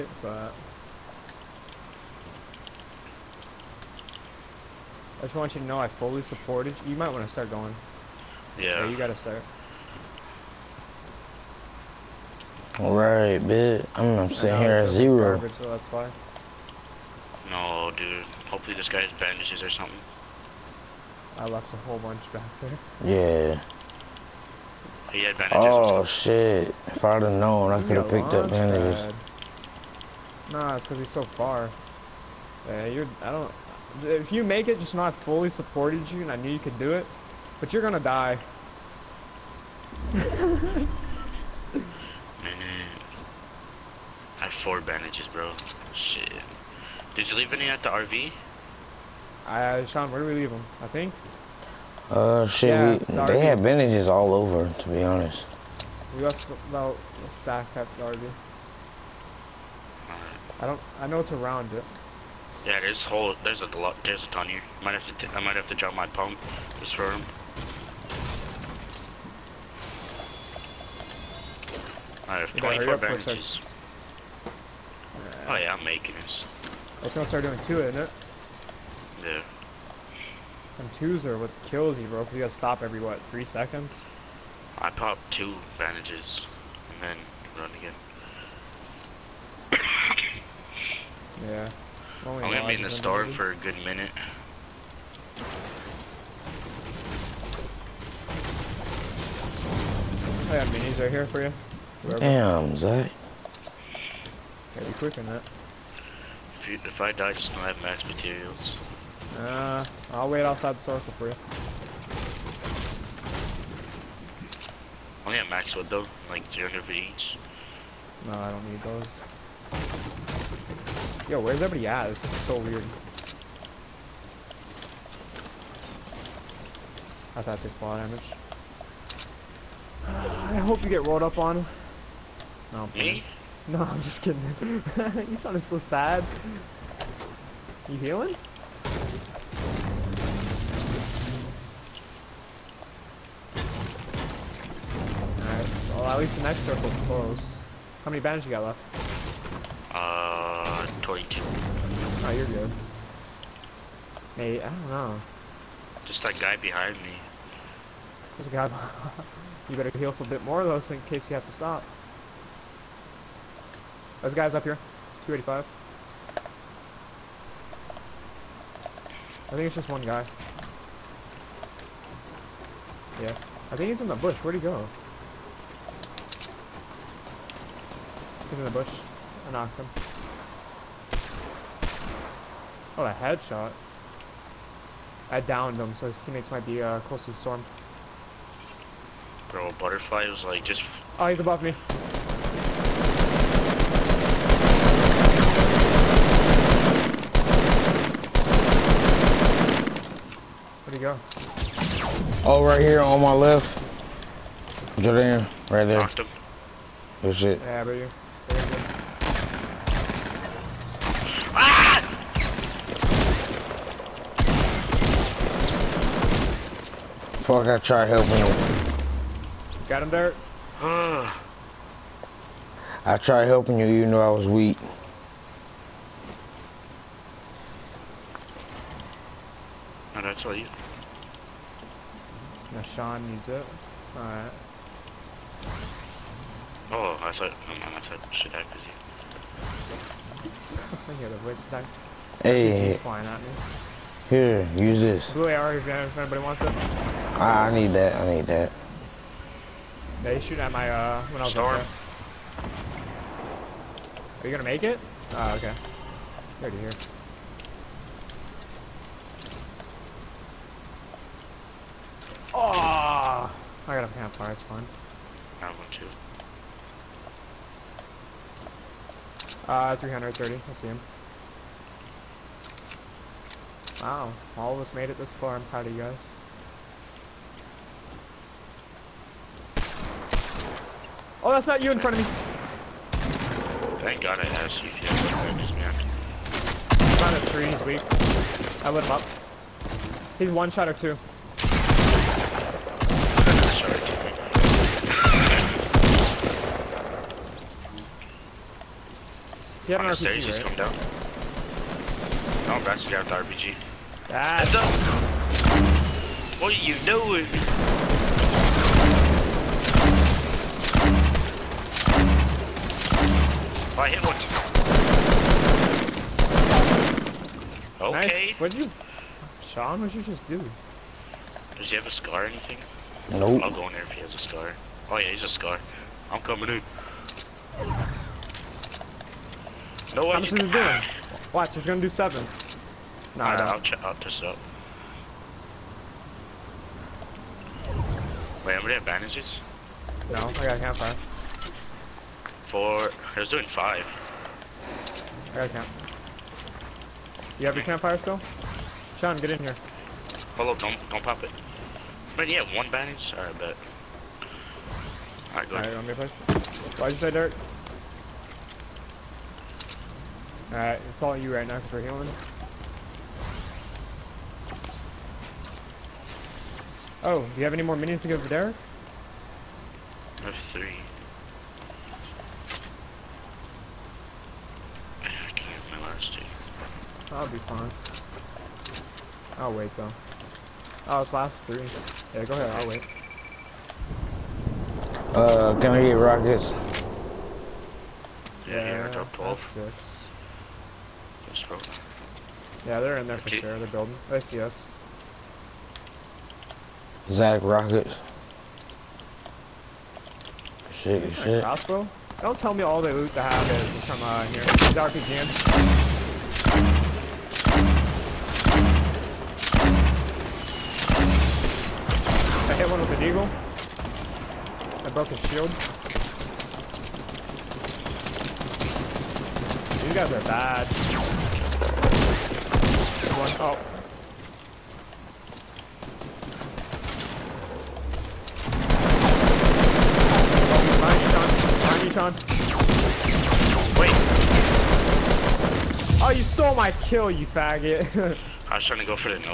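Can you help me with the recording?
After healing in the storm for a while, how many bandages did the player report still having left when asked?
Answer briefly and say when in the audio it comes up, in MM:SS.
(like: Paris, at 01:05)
22, at 02:31.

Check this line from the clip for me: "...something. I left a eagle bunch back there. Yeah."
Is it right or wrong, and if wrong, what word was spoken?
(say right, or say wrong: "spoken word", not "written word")
wrong: "whole", not "eagle".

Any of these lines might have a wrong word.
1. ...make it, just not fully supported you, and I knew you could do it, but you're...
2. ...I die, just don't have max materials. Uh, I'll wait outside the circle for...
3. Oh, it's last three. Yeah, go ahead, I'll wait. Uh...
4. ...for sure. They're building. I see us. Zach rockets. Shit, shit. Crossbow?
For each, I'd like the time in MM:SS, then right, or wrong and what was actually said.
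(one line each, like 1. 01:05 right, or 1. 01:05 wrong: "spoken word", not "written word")
1. 00:34 right
2. 01:47 right
3. 06:21 right
4. 06:33 right.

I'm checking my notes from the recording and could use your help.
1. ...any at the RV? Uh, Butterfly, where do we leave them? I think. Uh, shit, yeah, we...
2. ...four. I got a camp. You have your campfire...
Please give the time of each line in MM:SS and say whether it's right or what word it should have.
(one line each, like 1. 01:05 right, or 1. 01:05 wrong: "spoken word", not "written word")
1. 00:47 wrong: "Sean", not "Butterfly"
2. 05:43 wrong: "five", not "four".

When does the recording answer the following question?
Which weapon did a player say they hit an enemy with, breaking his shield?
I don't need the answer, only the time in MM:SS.
06:53.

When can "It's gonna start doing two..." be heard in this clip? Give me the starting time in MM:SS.
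01:17.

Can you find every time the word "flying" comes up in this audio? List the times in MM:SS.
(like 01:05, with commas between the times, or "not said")
04:02.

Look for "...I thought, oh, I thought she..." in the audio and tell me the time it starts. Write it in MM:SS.
03:57.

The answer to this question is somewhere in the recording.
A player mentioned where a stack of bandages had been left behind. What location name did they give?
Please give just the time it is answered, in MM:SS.
00:57.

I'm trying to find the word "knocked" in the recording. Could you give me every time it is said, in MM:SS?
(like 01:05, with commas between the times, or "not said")
02:59, 03:25.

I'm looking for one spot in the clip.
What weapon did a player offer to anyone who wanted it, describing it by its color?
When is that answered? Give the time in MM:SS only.
04:05.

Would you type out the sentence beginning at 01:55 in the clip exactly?
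Oh yeah, max wood though, like for each.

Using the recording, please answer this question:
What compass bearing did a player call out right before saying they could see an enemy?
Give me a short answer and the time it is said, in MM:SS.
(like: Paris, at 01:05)
330, at 04:29.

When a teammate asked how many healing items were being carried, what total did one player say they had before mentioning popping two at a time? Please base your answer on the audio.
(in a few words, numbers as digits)
24.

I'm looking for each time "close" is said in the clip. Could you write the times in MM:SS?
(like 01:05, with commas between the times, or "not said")
02:27, 03:07.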